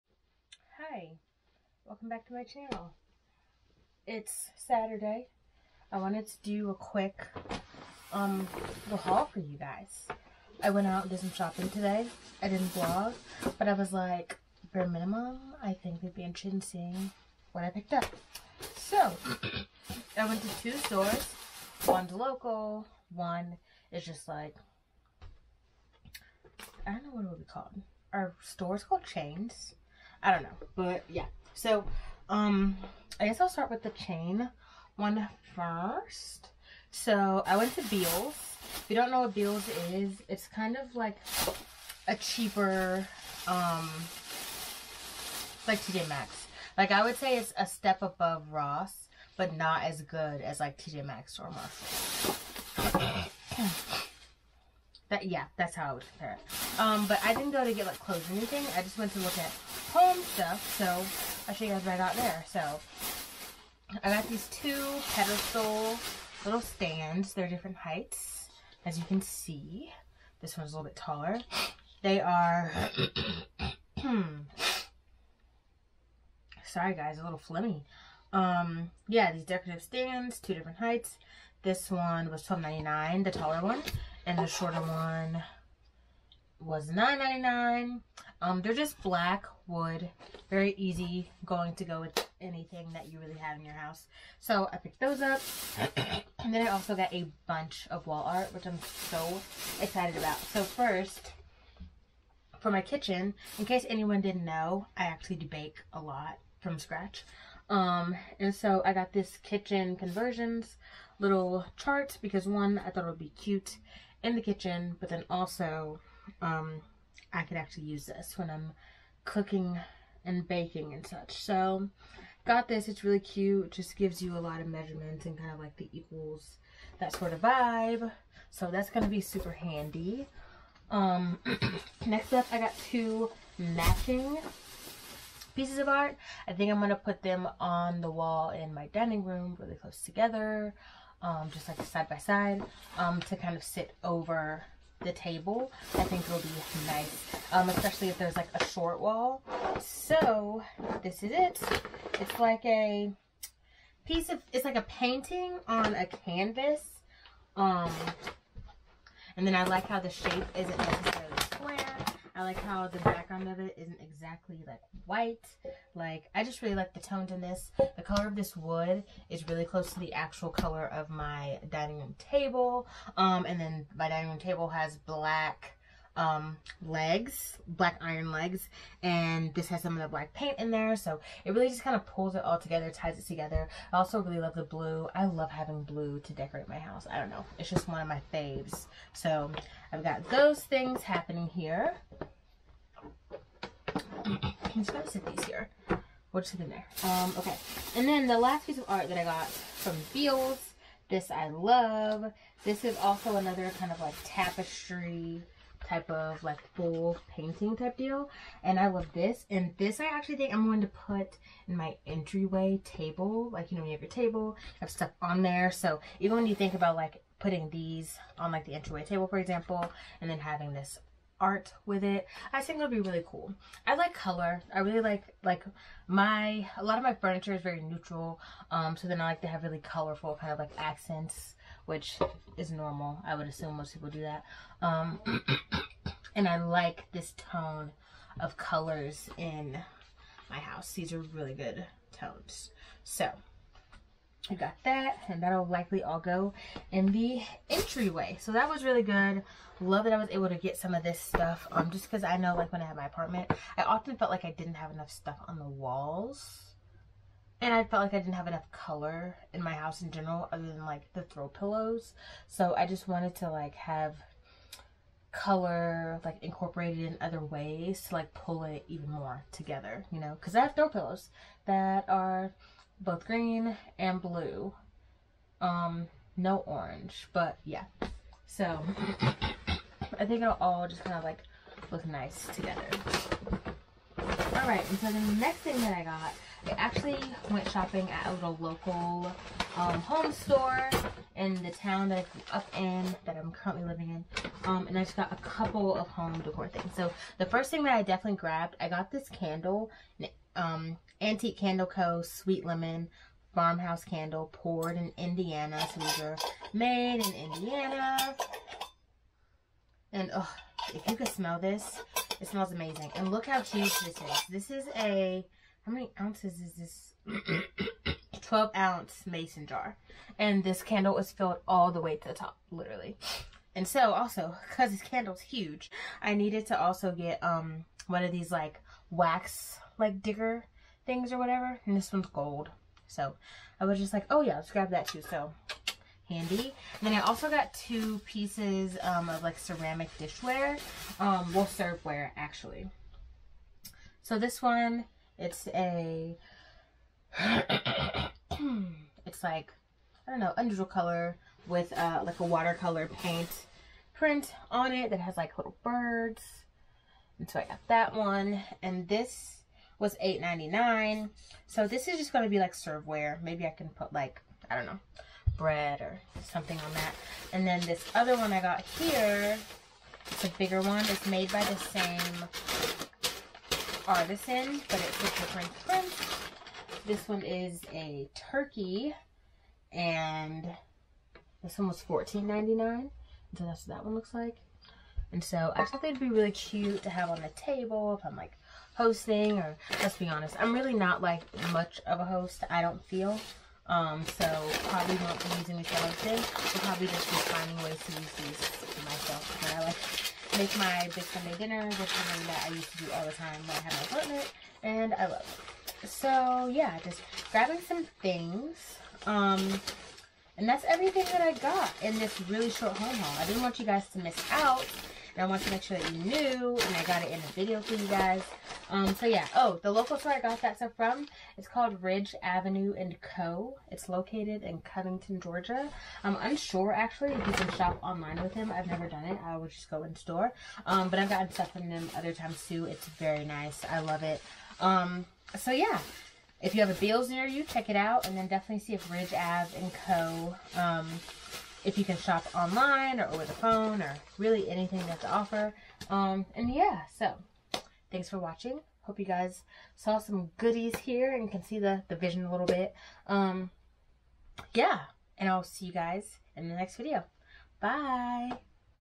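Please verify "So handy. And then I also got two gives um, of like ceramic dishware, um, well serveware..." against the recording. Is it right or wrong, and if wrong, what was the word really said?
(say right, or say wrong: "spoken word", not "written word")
wrong: "pieces", not "gives".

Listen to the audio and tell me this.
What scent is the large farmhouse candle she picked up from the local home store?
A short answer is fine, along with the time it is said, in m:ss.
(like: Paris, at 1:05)
Sweet Lemon, at 5:02.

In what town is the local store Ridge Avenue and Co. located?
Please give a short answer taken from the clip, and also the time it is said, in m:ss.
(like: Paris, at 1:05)
Covington, Georgia, at 7:04.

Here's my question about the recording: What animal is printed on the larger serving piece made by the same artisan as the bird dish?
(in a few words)
Turkey.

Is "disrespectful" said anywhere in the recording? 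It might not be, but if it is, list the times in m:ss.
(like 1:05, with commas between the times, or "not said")
not said.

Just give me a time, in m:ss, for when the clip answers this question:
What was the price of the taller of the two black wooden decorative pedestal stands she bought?
1:22.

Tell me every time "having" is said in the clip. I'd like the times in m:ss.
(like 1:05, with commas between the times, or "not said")
3:05, 3:40.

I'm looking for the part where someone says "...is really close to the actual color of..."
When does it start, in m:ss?
2:49.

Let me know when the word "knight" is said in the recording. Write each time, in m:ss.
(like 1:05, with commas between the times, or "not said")
not said.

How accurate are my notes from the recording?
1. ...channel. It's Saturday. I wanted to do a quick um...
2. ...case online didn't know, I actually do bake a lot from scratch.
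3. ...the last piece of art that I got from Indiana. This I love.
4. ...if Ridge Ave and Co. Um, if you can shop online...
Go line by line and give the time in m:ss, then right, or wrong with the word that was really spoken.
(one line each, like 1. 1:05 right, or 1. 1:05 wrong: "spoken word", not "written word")
1. 0:02 right
2. 1:43 wrong: "anyone", not "online"
3. 3:18 wrong: "Beals", not "Indiana"
4. 7:18 right.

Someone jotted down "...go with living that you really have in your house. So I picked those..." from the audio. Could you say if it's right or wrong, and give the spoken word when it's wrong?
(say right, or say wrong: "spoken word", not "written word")
wrong: "anything", not "living".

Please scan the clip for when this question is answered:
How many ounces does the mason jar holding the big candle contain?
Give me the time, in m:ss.
5:18.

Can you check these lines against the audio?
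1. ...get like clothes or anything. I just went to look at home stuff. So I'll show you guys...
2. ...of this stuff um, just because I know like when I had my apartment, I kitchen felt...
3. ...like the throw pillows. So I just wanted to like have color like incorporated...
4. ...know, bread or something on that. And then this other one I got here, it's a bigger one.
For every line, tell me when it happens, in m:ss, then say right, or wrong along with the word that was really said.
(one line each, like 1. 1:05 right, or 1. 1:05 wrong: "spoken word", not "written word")
1. 0:57 right
2. 4:10 wrong: "often", not "kitchen"
3. 4:20 right
4. 6:04 right.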